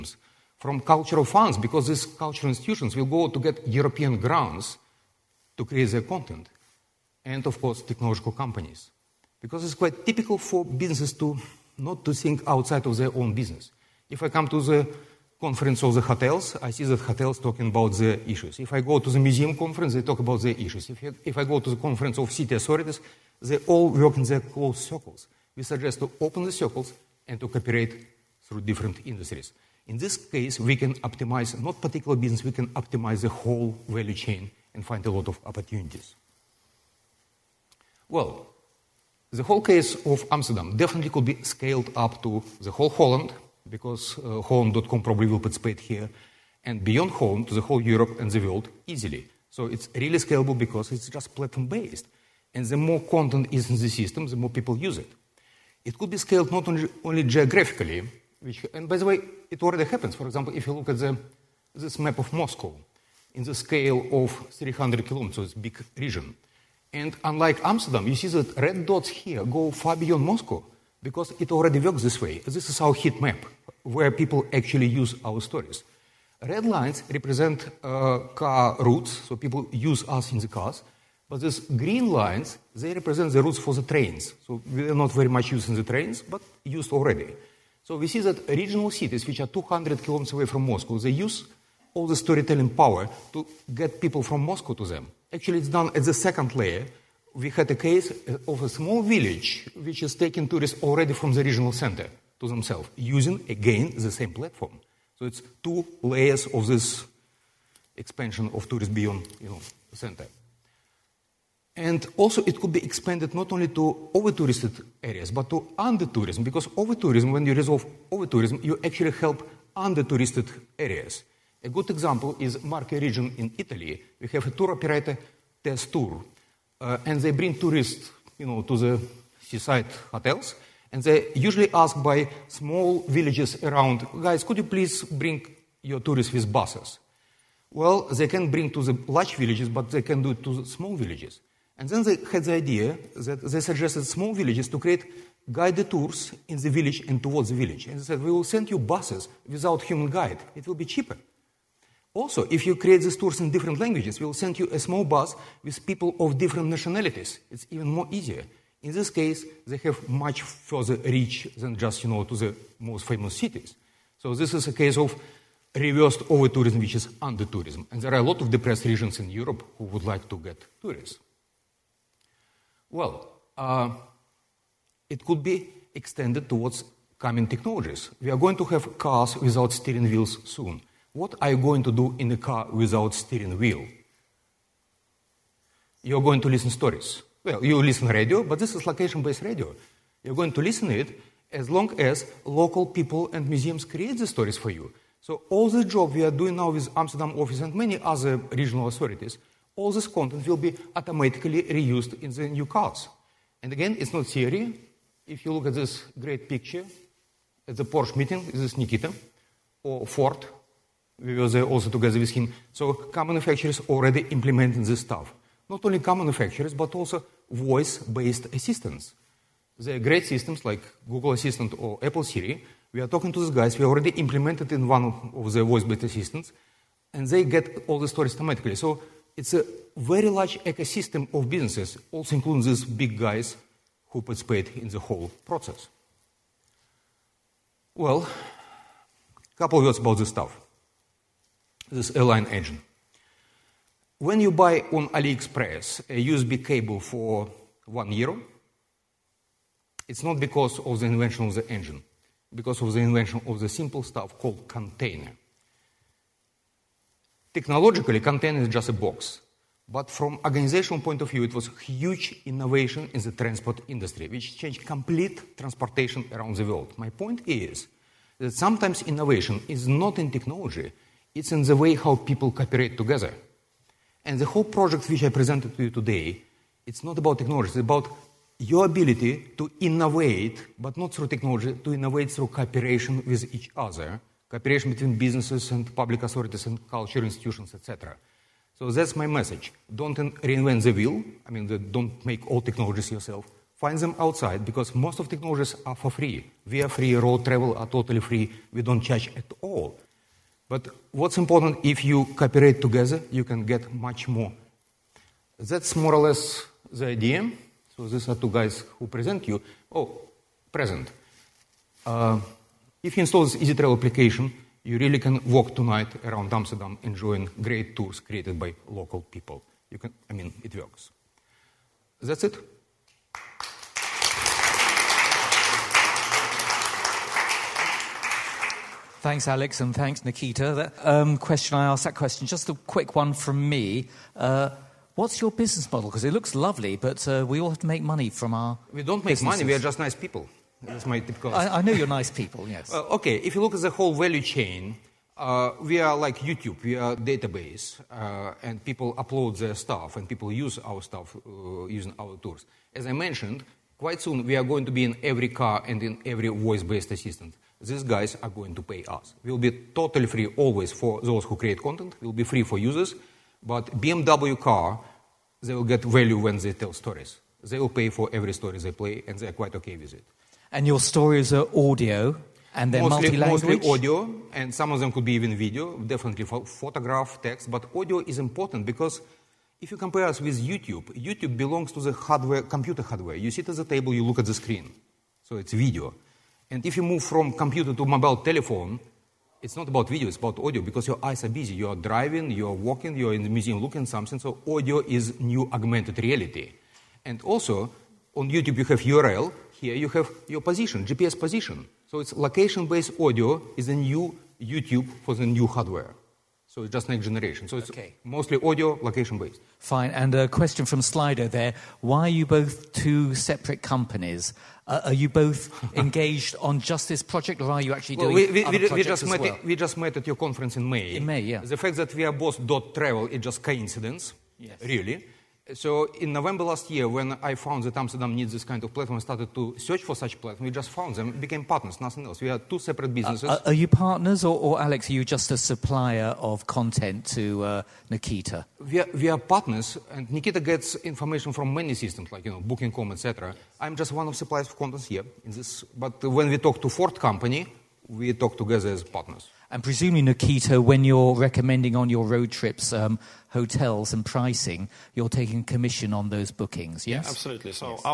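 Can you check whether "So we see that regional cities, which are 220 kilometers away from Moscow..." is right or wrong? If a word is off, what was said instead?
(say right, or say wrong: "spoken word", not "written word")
wrong: "200", not "220".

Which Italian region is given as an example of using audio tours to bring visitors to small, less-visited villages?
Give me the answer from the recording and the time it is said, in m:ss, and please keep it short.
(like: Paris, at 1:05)
Marche, at 2:02.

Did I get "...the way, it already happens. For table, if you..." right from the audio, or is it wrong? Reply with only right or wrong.
wrong.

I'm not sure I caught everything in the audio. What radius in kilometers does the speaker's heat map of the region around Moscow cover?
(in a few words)
300 kilometers.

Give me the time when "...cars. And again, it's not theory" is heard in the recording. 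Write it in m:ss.
3:22.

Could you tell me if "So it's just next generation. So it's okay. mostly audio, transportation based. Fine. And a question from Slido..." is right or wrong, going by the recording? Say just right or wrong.
wrong.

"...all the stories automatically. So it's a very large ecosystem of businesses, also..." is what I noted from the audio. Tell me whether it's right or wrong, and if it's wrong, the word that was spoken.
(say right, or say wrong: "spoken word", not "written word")
right.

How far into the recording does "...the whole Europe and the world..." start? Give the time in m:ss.
0:47.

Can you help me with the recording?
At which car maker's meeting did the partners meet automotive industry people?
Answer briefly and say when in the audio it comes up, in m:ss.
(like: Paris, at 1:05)
Porsche, at 3:27.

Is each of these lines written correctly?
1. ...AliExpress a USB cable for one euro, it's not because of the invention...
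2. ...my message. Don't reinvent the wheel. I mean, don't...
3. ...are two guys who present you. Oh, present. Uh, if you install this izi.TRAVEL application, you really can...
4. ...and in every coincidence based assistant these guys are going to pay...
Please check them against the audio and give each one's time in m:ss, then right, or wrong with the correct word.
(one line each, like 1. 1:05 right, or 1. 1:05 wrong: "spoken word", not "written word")
1. 4:05 right
2. 4:49 right
3. 5:08 right
4. 5:55 wrong: "voice", not "coincidence".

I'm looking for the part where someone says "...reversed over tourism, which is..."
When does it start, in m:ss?
2:45.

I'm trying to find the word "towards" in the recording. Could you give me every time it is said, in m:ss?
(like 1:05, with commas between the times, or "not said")
2:27, 2:56.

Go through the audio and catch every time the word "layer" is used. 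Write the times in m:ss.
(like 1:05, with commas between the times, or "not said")
1:36, 1:46.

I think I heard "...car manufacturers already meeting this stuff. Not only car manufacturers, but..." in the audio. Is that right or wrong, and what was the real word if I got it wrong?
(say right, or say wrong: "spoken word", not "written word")
wrong: "implementing", not "meeting".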